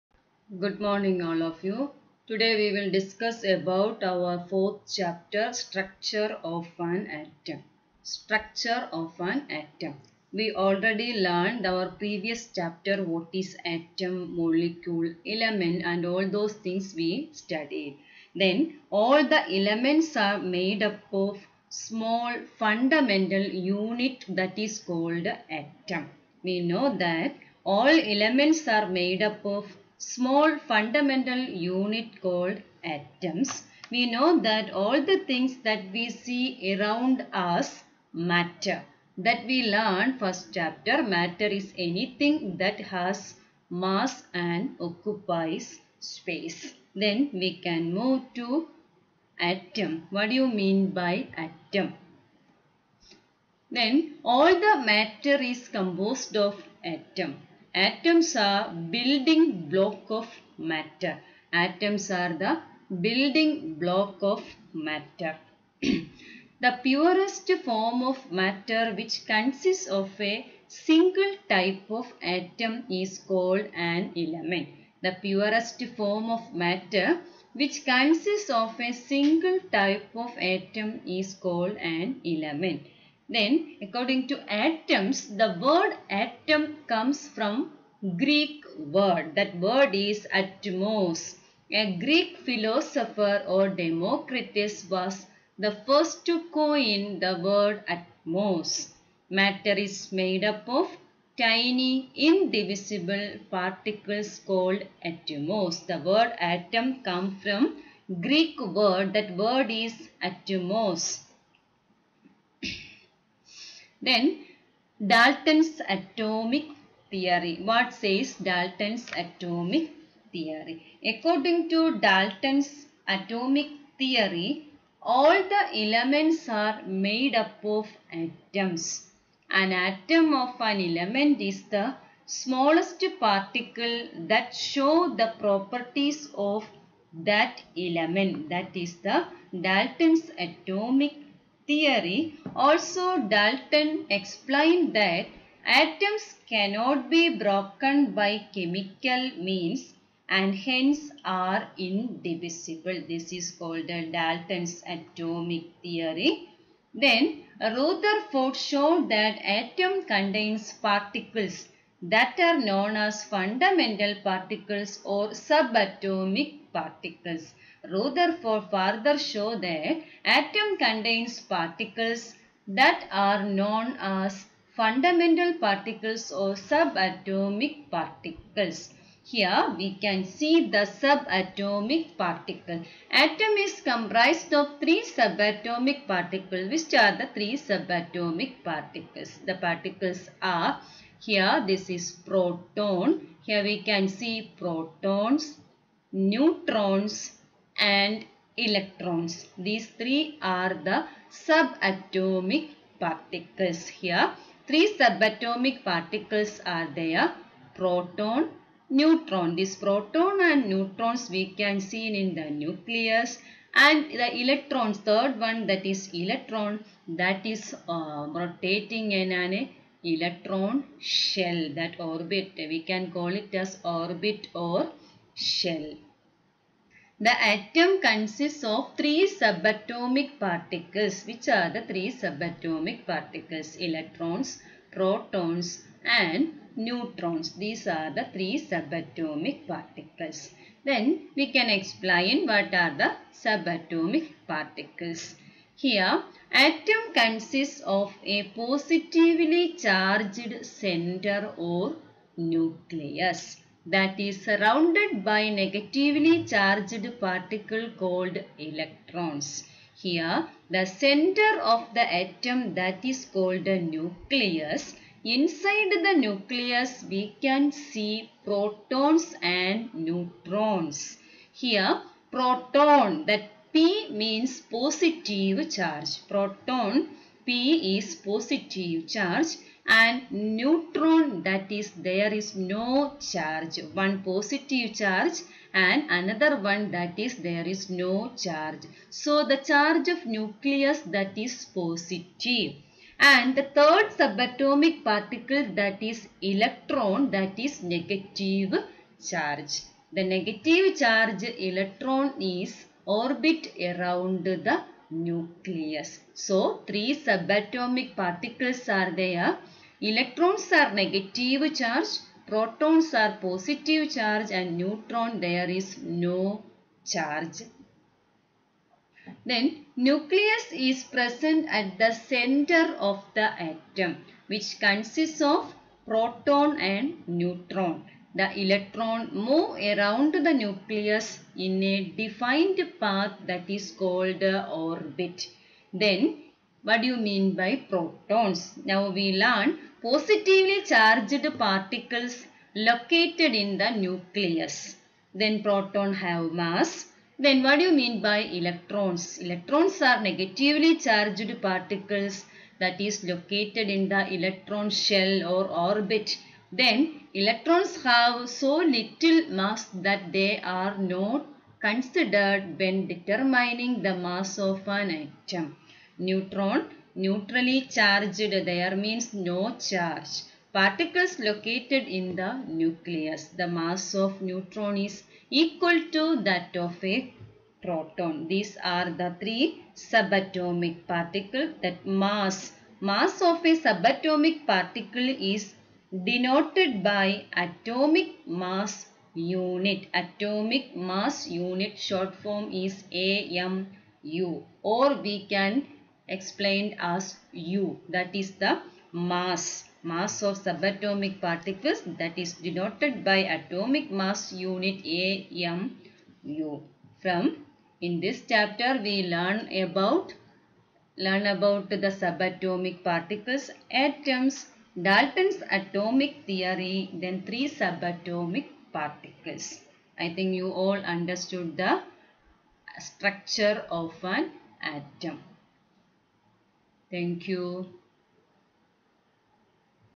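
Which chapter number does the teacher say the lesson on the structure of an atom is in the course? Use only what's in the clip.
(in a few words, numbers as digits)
fourth.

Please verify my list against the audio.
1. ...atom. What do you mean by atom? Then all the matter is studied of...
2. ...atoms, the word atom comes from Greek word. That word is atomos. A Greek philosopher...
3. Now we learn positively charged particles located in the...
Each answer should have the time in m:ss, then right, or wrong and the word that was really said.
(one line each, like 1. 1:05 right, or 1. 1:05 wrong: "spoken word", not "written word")
1. 0:49 wrong: "composed", not "studied"
2. 1:24 right
3. 5:38 right.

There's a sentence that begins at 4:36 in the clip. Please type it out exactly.
Proton P is positive charge and neutron that is there is no charge.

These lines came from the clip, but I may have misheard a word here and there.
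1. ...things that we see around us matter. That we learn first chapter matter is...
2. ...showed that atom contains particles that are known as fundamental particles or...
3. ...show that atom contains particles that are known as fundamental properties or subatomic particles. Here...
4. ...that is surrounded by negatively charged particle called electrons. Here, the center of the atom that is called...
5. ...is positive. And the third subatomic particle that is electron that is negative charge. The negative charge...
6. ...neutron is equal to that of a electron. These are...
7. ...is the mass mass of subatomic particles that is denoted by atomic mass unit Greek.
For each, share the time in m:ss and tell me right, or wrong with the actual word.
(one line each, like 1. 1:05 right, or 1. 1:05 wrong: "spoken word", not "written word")
1. 0:35 right
2. 2:38 right
3. 2:49 wrong: "particles", not "properties"
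4. 4:13 right
5. 4:51 right
6. 6:14 wrong: "proton", not "electron"
7. 6:38 wrong: "AMU", not "Greek".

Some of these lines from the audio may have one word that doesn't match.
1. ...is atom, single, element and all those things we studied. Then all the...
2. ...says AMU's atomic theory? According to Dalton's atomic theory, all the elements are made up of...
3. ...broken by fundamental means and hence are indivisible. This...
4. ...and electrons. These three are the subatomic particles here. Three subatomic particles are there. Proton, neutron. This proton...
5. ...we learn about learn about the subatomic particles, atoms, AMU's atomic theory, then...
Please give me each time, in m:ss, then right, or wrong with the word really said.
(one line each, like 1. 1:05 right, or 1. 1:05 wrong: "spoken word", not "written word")
1. 0:13 wrong: "molecule", not "single"
2. 1:57 wrong: "Dalton", not "AMU"
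3. 2:27 wrong: "chemical", not "fundamental"
4. 3:17 right
5. 6:49 wrong: "Dalton", not "AMU".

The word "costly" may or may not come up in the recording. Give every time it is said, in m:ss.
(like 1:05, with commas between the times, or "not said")
not said.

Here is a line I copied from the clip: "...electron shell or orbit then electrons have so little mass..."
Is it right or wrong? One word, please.
right.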